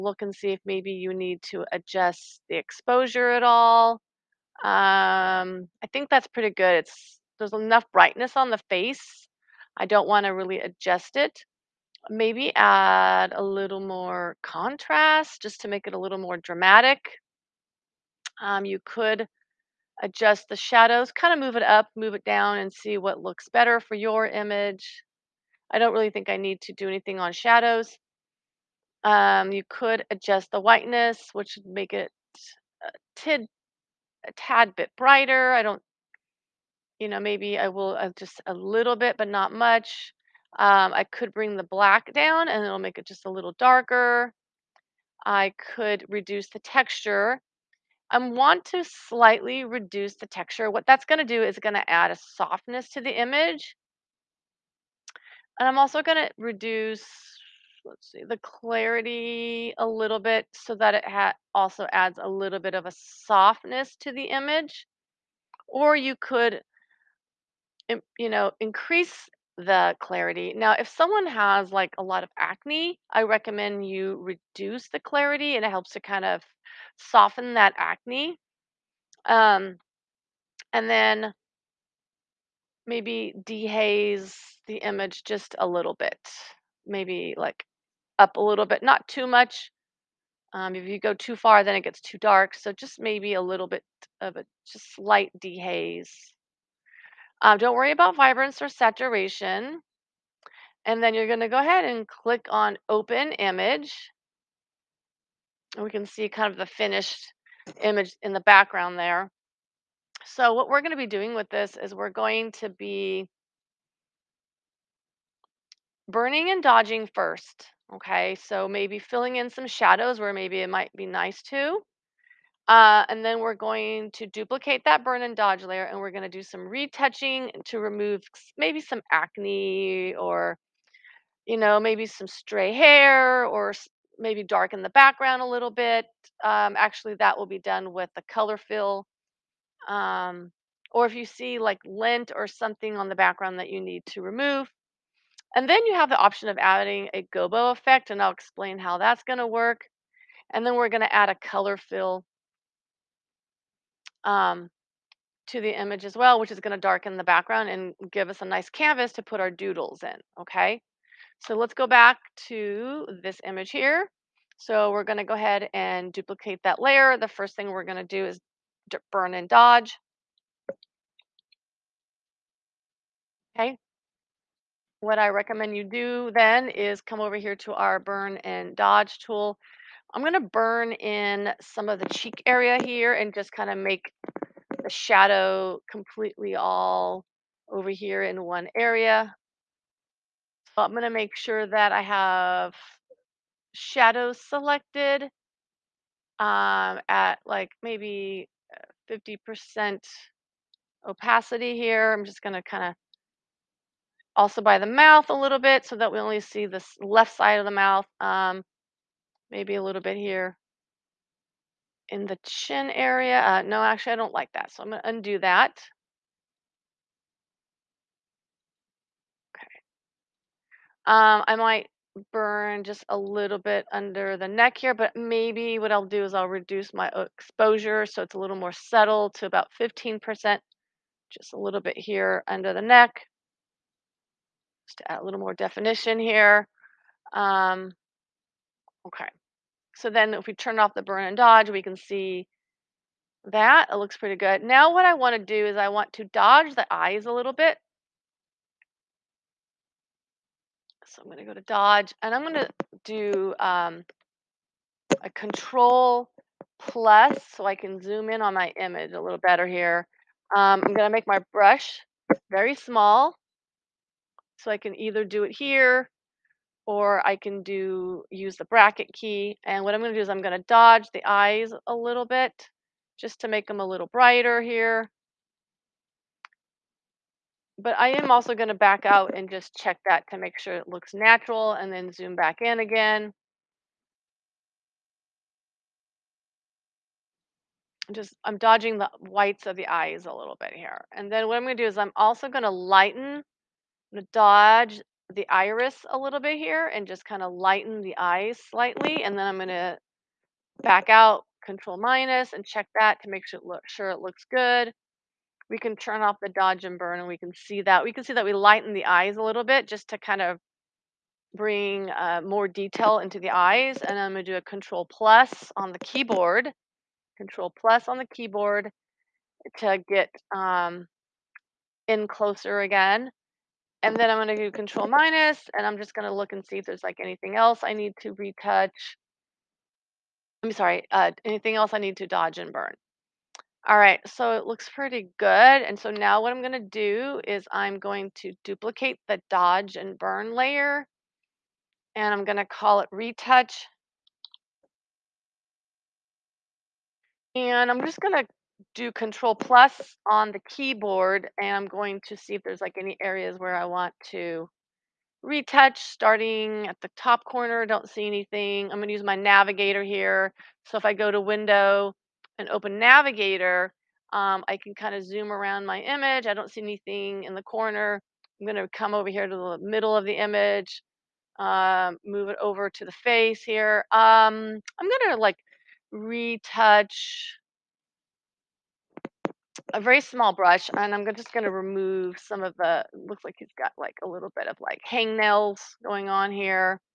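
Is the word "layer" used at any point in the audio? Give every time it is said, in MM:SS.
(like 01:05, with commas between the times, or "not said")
02:05, 02:46, 05:40.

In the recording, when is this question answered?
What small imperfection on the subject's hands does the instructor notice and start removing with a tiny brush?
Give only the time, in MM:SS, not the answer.
06:25.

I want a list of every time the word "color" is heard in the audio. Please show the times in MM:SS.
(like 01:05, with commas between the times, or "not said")
02:18, 02:31.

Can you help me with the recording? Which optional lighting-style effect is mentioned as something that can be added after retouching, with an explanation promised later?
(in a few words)
gobo effect.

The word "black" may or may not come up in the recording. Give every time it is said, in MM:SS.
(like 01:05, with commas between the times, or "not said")
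00:41.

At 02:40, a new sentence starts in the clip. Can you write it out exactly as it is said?
Okay, so let's go back to this image here.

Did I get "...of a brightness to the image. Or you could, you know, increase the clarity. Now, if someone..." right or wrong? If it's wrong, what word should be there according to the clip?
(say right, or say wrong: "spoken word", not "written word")
wrong: "softness", not "brightness".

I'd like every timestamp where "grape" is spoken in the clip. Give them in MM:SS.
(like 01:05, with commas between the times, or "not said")
not said.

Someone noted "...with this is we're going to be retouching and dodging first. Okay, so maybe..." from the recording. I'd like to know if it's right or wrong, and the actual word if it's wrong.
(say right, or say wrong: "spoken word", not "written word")
wrong: "burning", not "retouching".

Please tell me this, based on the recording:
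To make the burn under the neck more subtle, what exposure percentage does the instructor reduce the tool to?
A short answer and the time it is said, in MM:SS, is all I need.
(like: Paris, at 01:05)
15%, at 03:49.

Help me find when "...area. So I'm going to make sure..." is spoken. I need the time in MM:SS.
03:08.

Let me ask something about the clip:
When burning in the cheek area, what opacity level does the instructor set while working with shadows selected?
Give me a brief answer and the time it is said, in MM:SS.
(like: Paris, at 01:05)
50%, at 03:19.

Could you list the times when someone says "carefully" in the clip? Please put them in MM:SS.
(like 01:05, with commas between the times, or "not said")
not said.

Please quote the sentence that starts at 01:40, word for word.
And then you're going to go ahead and click on open image.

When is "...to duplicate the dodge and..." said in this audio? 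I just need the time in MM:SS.
05:38.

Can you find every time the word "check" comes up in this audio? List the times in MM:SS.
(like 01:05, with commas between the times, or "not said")
04:39, 05:02.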